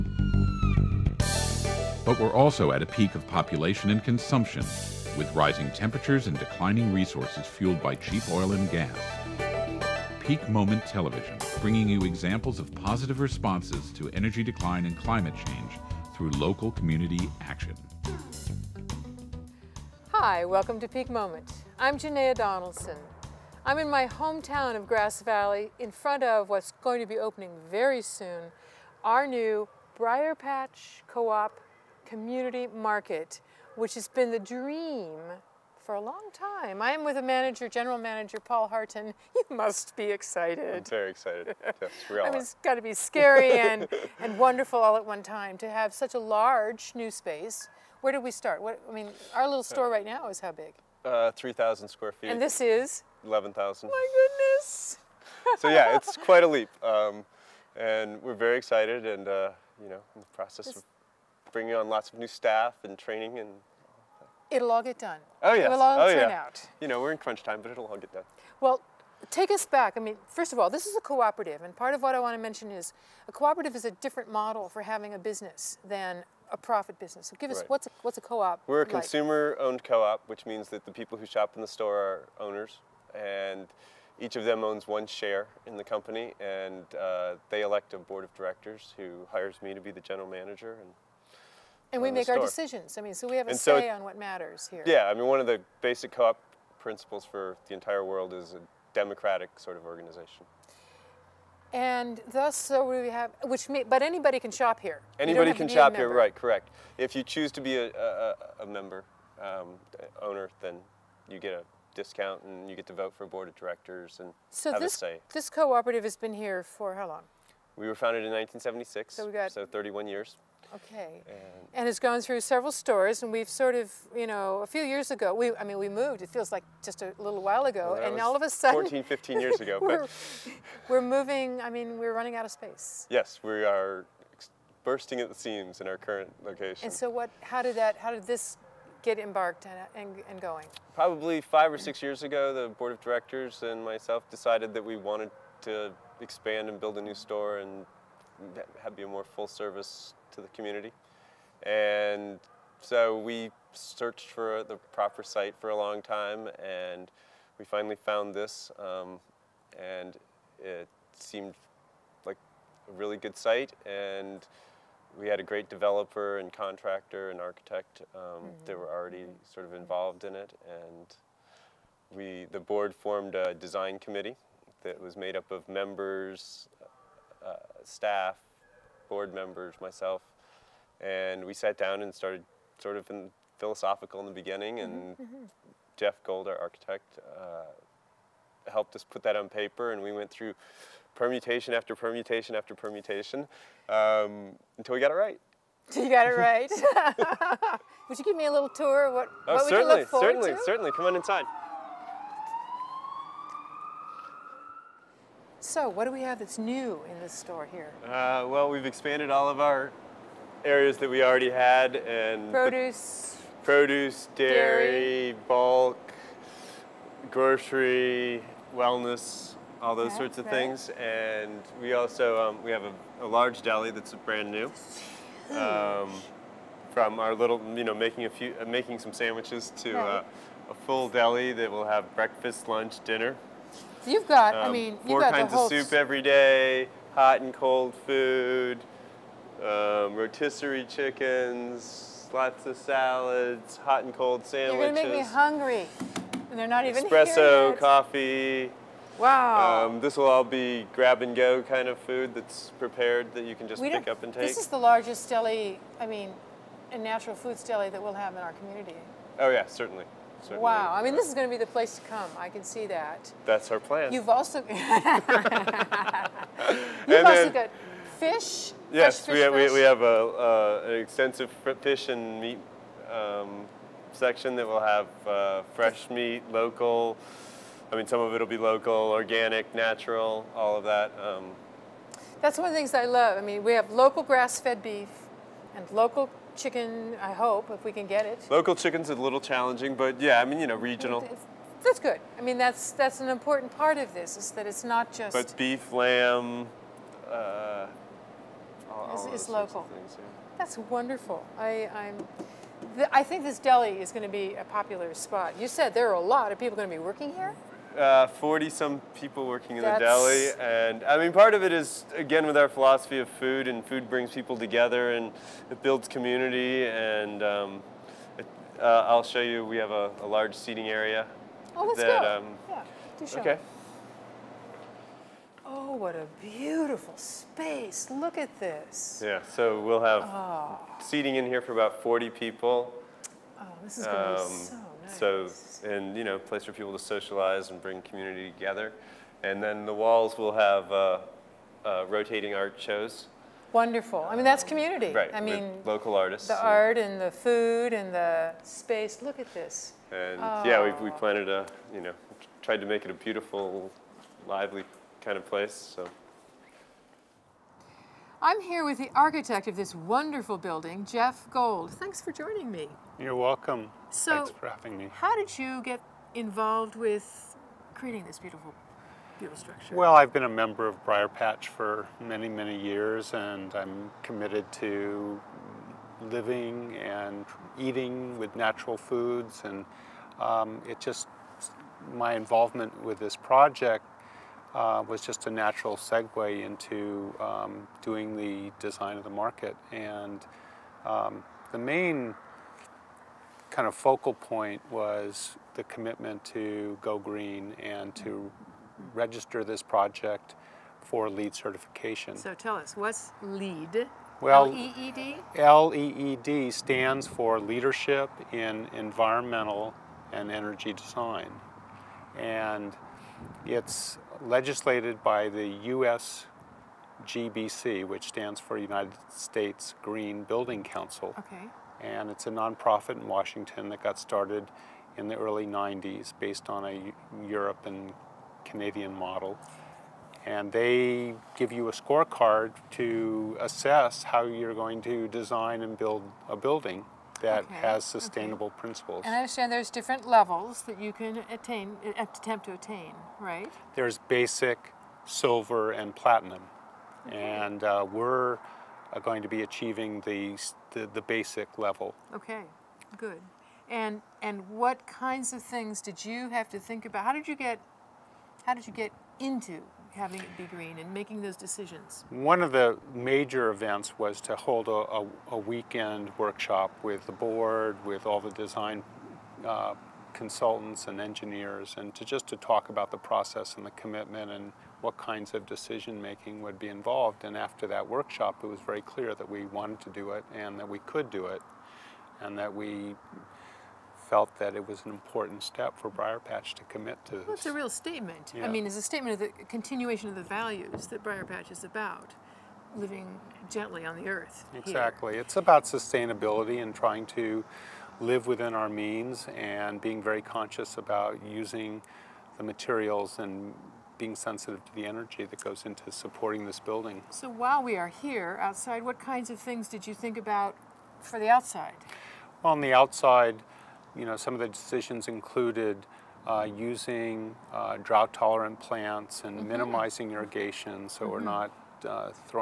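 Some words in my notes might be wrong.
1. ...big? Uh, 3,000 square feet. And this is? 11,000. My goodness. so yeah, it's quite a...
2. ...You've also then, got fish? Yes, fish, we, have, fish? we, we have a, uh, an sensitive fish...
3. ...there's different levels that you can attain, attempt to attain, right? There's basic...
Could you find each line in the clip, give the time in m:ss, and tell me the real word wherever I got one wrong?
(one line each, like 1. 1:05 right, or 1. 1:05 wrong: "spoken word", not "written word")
1. 0:50 right
2. 4:24 wrong: "extensive", not "sensitive"
3. 7:19 right.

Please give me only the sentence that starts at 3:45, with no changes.
Um, from our little, you know, making a few, uh, making some sandwiches to right.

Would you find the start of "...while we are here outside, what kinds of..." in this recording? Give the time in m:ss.
8:27.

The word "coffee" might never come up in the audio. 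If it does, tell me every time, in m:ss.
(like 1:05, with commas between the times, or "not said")
4:07.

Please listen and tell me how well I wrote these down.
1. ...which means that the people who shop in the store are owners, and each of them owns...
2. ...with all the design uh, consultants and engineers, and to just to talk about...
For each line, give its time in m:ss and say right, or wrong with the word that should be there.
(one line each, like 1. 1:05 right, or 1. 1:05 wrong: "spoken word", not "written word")
1. 1:20 right
2. 7:48 right.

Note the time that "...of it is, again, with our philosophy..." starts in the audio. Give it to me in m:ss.
5:11.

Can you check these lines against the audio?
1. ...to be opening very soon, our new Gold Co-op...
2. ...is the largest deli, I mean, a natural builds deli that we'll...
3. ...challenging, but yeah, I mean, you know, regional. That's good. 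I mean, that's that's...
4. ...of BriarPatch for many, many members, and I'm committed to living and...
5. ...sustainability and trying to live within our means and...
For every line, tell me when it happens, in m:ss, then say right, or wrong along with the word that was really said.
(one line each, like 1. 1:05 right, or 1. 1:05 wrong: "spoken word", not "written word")
1. 0:27 wrong: "BriarPatch", not "Gold"
2. 4:14 wrong: "foods", not "builds"
3. 4:49 right
4. 6:10 wrong: "years", not "members"
5. 8:15 right.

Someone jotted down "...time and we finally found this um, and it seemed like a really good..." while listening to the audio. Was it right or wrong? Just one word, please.
right.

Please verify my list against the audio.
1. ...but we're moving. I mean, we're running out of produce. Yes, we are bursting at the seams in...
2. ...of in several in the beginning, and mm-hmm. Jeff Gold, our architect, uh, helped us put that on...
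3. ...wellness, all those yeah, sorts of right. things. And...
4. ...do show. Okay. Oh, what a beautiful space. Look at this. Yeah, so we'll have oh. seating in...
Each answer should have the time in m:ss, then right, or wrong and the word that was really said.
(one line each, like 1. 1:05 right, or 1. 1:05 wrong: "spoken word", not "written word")
1. 2:10 wrong: "space", not "produce"
2. 3:02 wrong: "philosophical", not "several"
3. 3:38 right
4. 5:23 right.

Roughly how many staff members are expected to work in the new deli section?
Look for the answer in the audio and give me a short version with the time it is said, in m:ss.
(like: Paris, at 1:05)
40 some, at 5:08.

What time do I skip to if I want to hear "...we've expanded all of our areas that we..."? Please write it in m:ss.
3:28.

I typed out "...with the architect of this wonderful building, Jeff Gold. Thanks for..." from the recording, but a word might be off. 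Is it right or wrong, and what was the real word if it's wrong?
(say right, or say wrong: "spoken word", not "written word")
right.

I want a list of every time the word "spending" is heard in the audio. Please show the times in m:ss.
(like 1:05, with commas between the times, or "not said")
not said.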